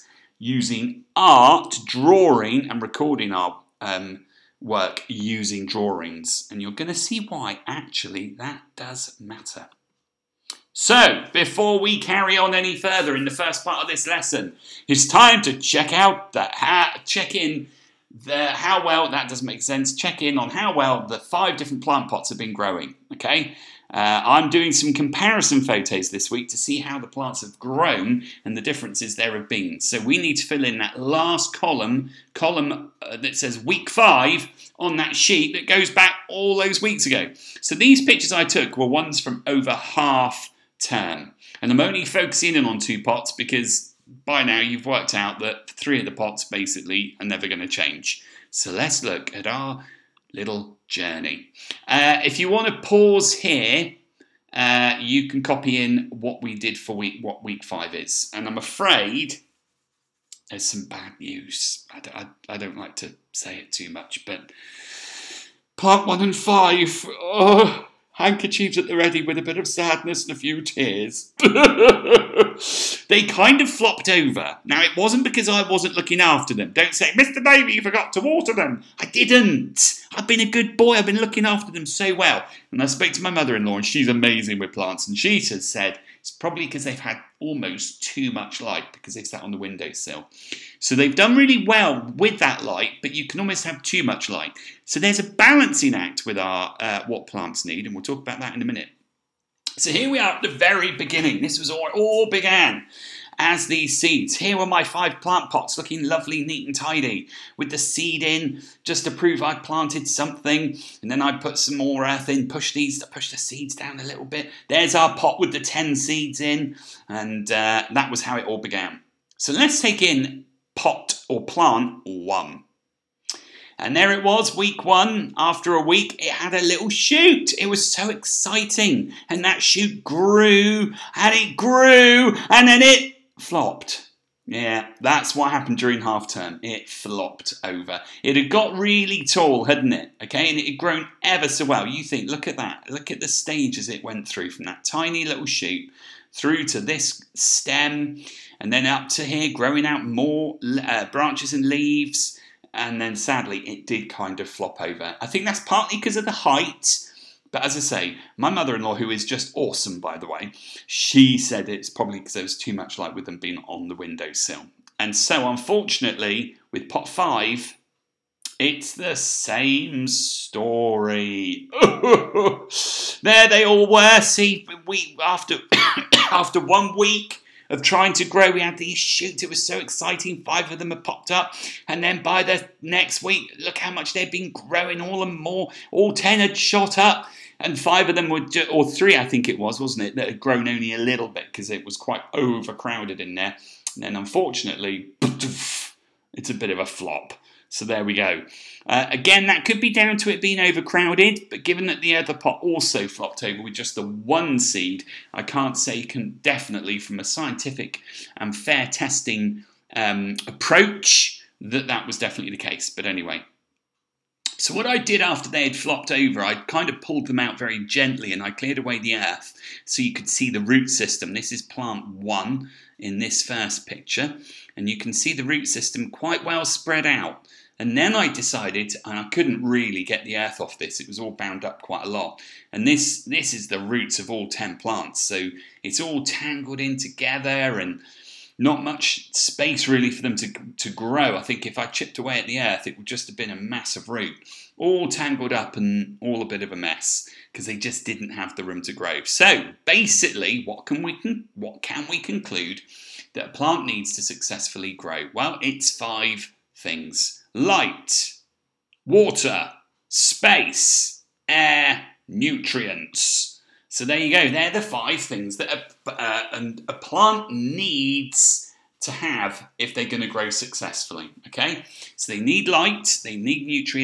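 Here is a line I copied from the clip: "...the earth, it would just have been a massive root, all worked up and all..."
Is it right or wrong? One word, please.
wrong.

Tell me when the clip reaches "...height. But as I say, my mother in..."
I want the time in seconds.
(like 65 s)
156 s.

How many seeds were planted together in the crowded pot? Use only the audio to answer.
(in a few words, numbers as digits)
10.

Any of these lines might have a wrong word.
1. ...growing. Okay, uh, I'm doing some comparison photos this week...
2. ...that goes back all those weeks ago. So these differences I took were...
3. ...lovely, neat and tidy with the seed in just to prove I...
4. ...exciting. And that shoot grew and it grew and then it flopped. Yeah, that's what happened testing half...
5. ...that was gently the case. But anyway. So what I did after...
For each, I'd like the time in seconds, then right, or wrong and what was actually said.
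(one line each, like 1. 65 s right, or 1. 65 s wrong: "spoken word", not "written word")
1. 22 s right
2. 35 s wrong: "pictures", not "differences"
3. 106 s right
4. 128 s wrong: "during", not "testing"
5. 211 s wrong: "definitely", not "gently".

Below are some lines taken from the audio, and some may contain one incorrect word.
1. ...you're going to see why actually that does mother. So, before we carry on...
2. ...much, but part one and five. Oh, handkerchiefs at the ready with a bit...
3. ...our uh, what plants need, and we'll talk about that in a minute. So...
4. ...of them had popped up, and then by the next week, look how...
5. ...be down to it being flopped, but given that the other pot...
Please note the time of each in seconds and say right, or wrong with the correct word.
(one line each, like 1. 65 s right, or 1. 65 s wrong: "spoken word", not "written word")
1. 6 s wrong: "matter", not "mother"
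2. 63 s right
3. 96 s right
4. 180 s right
5. 199 s wrong: "overcrowded", not "flopped".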